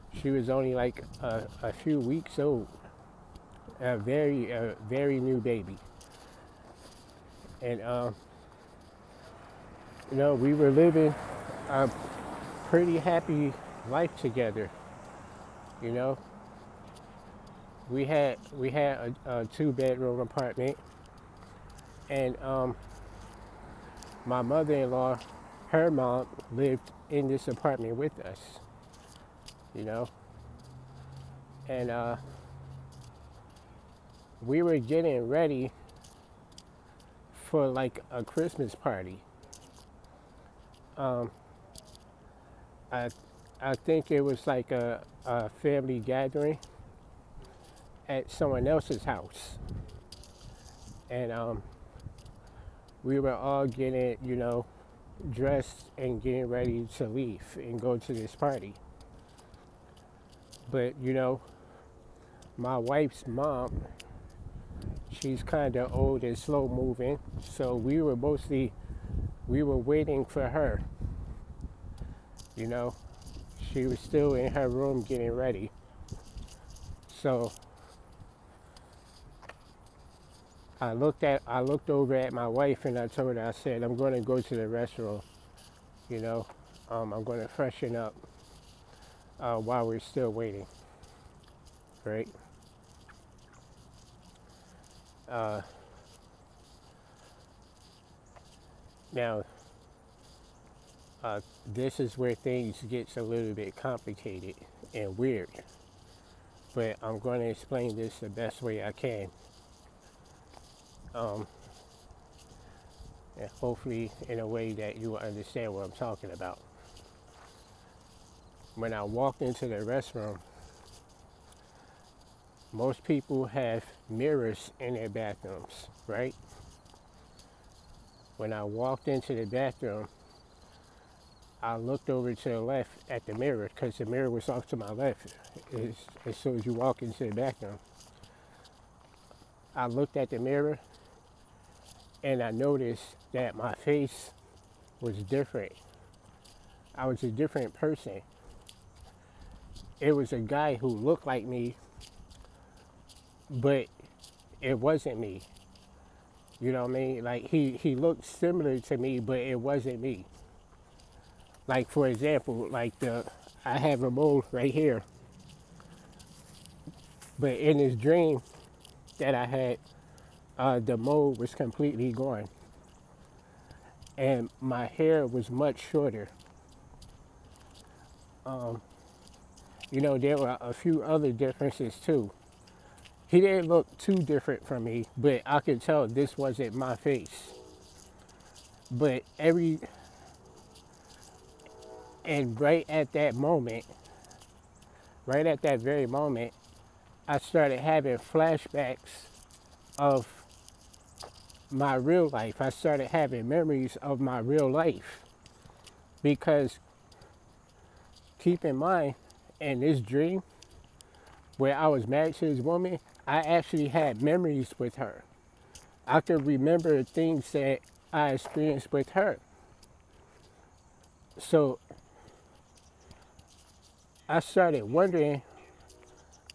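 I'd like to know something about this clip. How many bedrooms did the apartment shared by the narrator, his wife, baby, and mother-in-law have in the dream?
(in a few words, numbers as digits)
2.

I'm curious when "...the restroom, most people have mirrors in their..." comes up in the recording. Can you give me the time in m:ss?
1:59.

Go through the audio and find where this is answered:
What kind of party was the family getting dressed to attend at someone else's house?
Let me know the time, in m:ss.
0:38.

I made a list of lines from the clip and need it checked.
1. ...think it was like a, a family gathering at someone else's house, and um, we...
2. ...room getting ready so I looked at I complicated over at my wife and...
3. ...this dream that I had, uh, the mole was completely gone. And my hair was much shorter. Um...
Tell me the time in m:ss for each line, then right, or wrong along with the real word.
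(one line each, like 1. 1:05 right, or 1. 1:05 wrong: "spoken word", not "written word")
1. 0:43 right
2. 1:14 wrong: "looked", not "complicated"
3. 2:47 right.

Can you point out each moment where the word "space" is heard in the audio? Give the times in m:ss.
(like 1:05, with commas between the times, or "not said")
not said.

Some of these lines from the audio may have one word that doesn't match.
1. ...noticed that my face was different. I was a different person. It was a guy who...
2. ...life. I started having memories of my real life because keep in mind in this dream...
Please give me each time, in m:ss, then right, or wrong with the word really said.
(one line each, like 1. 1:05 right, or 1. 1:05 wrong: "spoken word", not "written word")
1. 2:22 right
2. 3:22 right.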